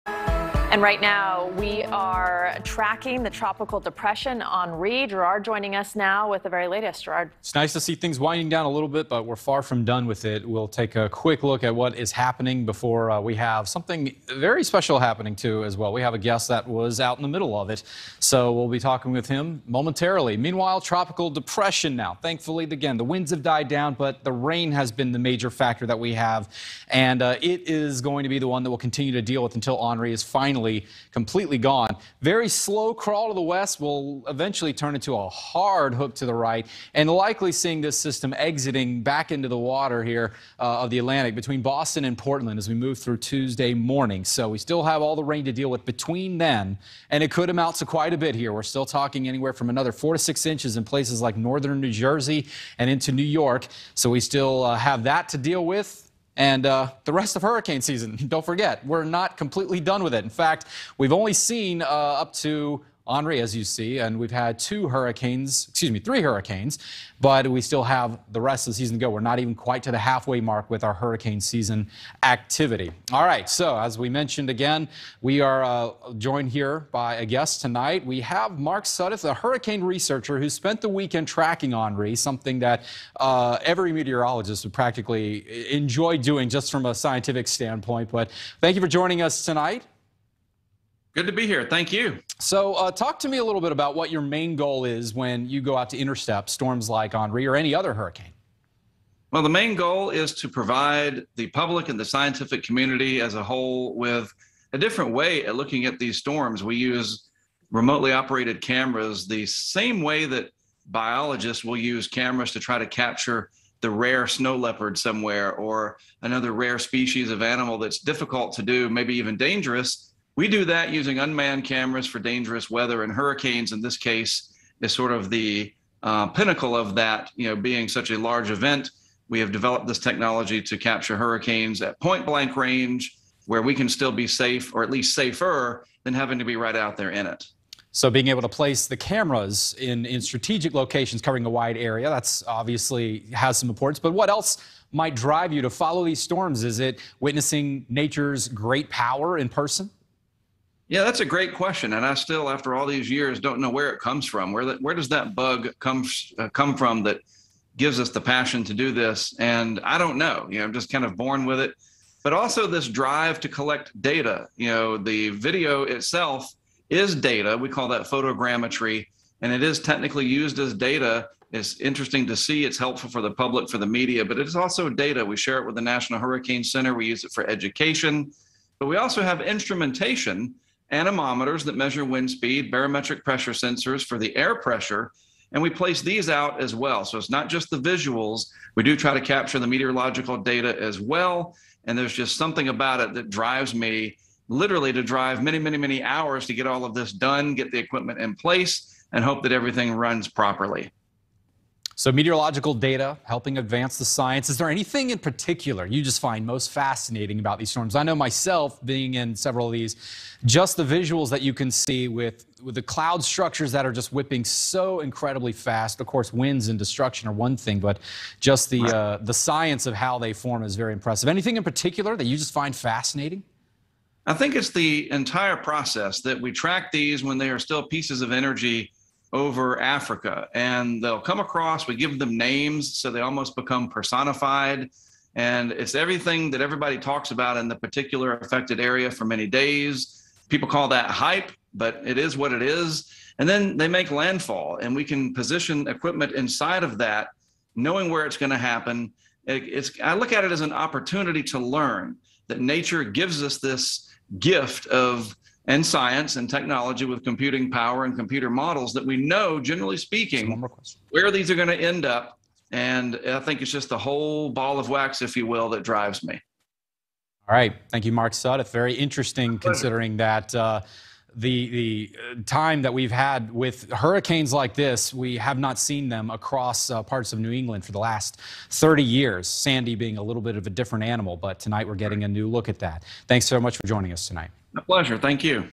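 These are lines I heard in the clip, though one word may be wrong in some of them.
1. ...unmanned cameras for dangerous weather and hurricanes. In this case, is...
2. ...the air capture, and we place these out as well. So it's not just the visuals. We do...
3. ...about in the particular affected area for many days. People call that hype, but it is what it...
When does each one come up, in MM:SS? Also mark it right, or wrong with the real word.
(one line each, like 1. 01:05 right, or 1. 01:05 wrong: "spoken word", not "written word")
1. 02:01 right
2. 03:04 wrong: "pressure", not "capture"
3. 03:57 right.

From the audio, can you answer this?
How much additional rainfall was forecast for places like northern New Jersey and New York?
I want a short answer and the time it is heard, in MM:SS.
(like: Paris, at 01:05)
4 to 6 inches, at 00:49.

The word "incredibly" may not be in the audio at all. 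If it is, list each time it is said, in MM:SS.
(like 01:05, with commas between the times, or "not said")
03:35.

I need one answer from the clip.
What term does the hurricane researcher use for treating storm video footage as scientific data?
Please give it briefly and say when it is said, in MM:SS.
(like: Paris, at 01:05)
photogrammetry, at 02:48.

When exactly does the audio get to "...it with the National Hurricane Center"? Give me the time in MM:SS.
02:55.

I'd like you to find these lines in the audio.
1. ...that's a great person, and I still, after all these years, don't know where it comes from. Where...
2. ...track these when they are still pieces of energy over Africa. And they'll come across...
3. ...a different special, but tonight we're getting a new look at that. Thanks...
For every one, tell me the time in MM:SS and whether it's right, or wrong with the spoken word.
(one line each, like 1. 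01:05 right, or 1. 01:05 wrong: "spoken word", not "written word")
1. 02:31 wrong: "question", not "person"
2. 03:46 right
3. 04:40 wrong: "animal", not "special".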